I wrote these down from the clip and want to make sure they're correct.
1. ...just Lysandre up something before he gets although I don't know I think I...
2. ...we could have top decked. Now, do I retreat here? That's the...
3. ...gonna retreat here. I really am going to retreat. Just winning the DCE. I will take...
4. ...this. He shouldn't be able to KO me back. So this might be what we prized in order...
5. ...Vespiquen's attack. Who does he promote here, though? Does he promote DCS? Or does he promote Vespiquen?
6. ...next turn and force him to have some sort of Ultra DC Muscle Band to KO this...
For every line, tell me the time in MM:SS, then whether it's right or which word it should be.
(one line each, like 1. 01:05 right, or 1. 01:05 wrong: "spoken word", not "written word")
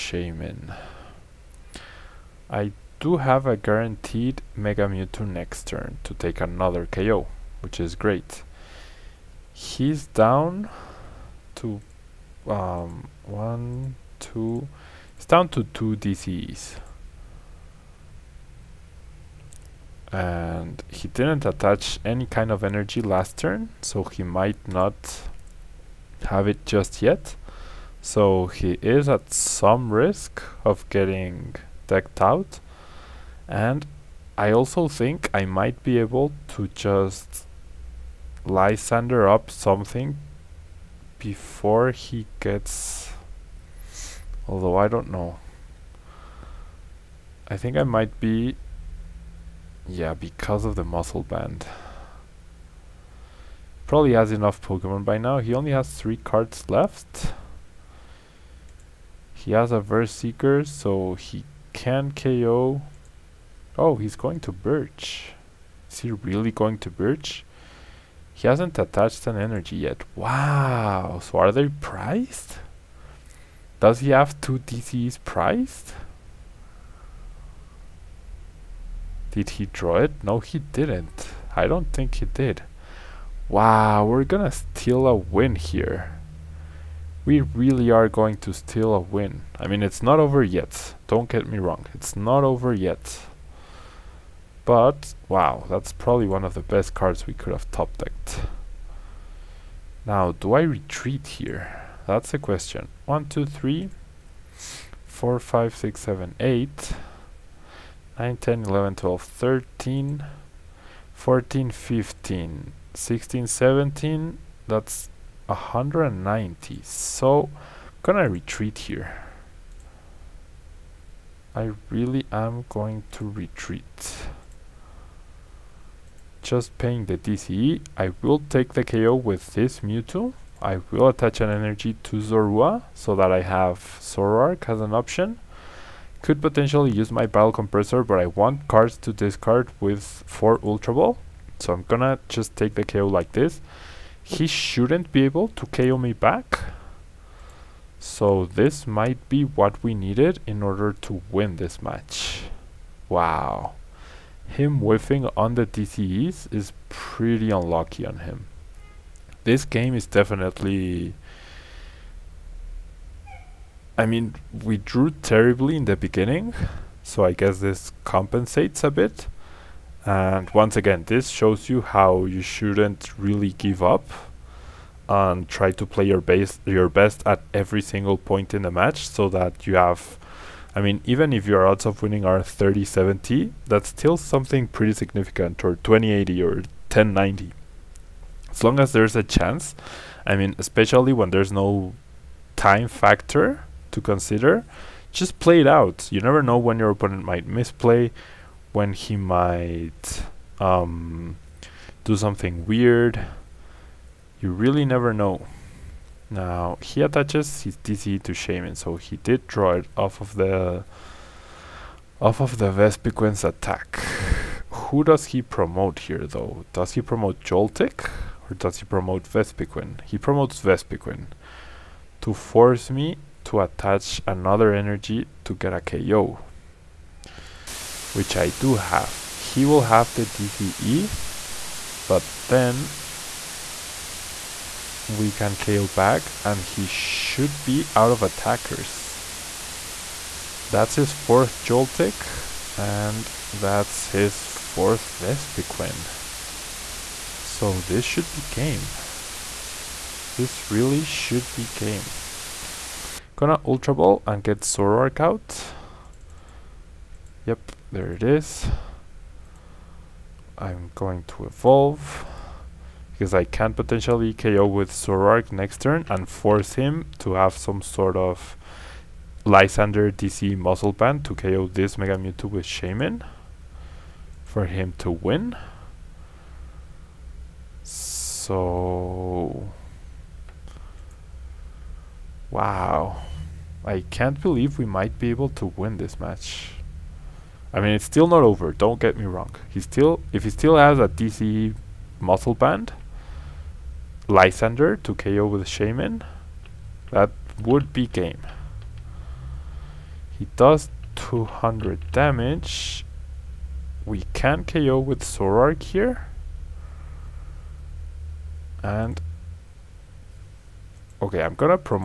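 1. 00:36 right
2. 01:37 right
3. 01:58 wrong: "paying", not "winning"
4. 02:23 wrong: "needed", not "prized"
5. 03:32 wrong: "Joltik", not "DCS"
6. 04:25 wrong: "Lysandre", not "Ultra".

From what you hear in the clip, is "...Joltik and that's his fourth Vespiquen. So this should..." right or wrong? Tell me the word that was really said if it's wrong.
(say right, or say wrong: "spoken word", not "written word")
right.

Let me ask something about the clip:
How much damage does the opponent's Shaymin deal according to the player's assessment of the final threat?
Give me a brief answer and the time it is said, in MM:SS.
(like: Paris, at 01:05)
200, at 05:01.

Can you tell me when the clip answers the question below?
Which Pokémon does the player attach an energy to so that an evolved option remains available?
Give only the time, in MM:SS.
02:12.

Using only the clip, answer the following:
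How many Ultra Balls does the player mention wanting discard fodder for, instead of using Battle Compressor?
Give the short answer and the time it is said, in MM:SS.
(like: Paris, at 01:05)
4, at 02:20.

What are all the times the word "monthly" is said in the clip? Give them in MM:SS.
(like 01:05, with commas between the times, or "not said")
not said.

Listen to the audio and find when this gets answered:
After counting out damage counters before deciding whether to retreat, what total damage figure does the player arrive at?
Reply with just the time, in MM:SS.
01:54.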